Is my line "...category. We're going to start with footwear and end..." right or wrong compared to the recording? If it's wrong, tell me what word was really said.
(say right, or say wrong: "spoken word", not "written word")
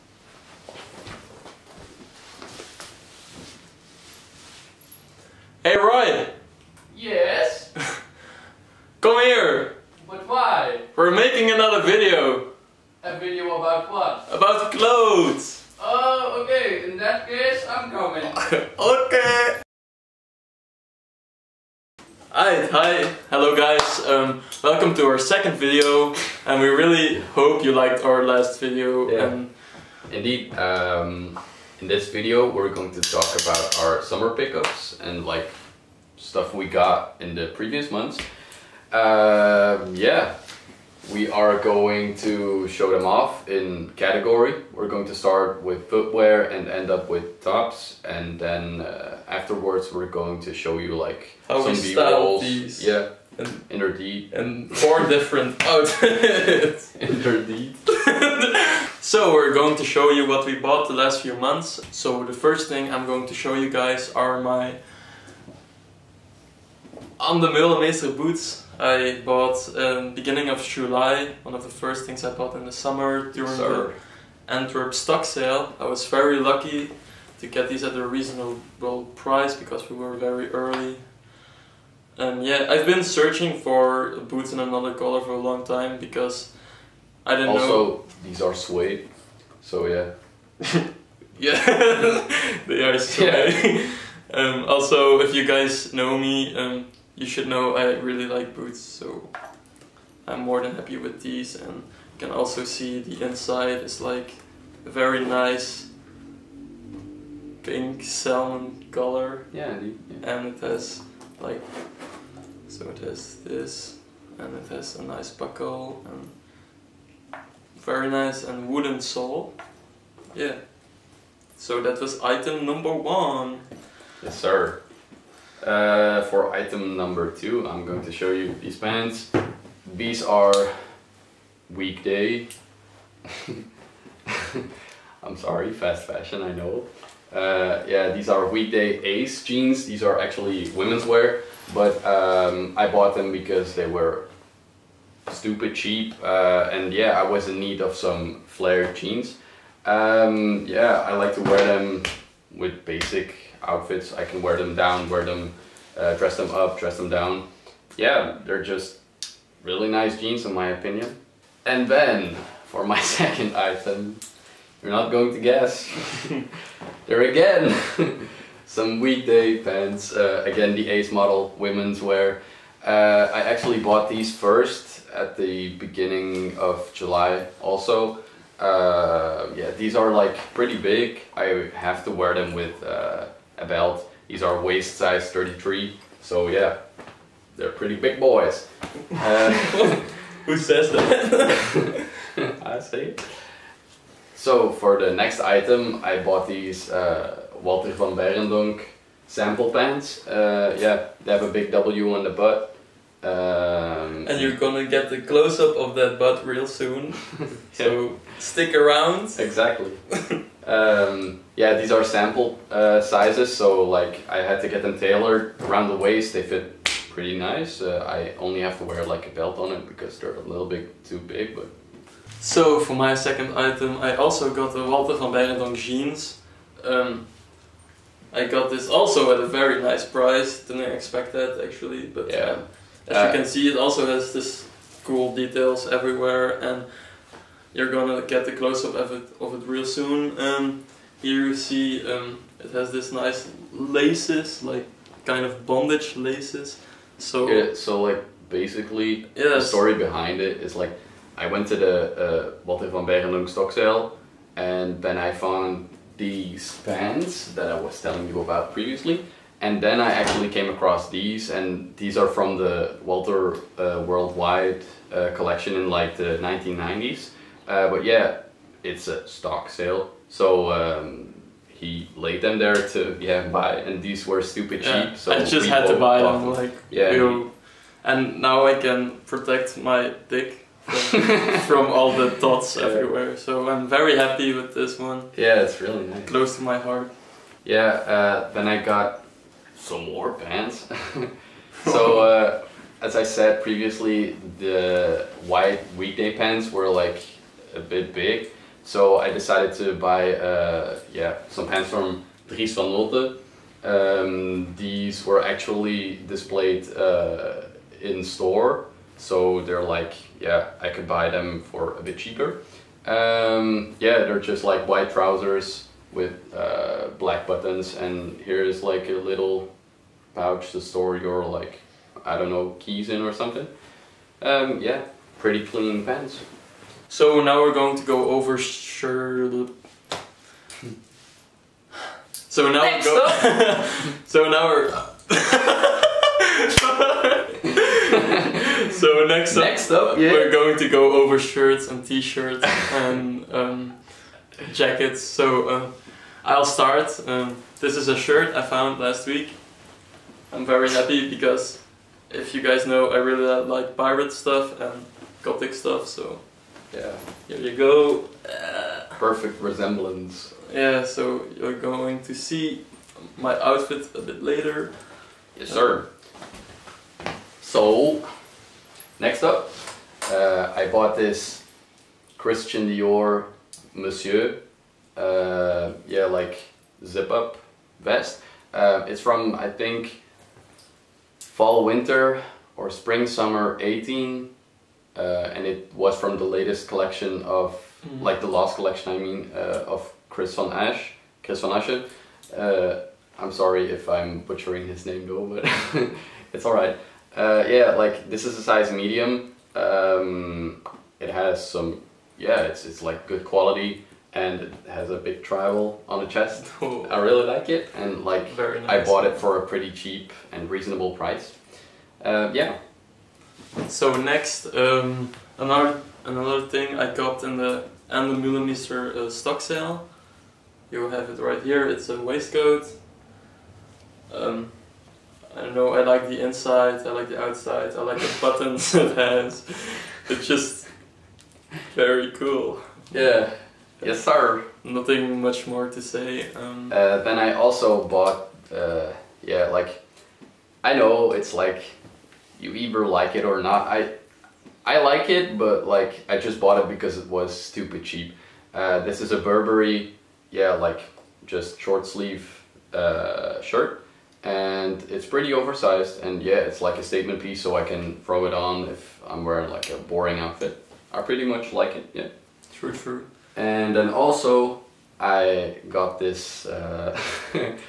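right.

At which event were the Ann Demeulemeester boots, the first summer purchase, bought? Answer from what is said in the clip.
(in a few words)
Antwerp stock sale.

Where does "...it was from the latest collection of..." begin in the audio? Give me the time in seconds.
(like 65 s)
385 s.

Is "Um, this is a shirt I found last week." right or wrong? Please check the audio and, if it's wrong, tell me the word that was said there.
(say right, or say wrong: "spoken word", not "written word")
right.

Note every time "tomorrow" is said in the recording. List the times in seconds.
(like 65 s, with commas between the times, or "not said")
not said.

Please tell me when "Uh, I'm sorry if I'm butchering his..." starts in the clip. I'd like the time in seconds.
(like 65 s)
392 s.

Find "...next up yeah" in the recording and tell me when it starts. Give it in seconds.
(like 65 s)
339 s.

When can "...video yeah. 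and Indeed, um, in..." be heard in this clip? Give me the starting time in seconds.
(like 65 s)
28 s.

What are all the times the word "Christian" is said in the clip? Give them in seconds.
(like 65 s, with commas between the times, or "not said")
372 s.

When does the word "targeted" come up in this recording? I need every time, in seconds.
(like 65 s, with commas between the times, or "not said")
not said.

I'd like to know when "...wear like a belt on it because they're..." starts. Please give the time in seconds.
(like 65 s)
218 s.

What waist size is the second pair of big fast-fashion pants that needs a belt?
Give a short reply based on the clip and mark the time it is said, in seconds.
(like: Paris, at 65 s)
33, at 185 s.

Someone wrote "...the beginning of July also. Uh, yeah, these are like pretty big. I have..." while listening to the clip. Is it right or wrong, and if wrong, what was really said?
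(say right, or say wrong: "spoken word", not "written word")
right.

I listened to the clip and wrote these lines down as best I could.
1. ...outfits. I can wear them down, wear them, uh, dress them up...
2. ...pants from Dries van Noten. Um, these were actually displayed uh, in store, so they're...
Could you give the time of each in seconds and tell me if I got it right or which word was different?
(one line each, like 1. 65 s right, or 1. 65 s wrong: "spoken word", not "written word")
1. 153 s right
2. 301 s right.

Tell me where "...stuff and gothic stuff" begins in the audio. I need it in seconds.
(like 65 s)
354 s.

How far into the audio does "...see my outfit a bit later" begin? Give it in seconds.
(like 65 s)
362 s.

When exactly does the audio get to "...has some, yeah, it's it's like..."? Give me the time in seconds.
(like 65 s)
401 s.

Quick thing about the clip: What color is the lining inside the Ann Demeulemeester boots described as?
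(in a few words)
pink salmon.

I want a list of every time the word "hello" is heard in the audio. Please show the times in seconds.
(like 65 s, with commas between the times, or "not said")
23 s.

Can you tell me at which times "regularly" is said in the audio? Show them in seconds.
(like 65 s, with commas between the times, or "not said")
not said.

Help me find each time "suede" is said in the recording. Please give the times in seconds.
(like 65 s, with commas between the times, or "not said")
88 s, 92 s.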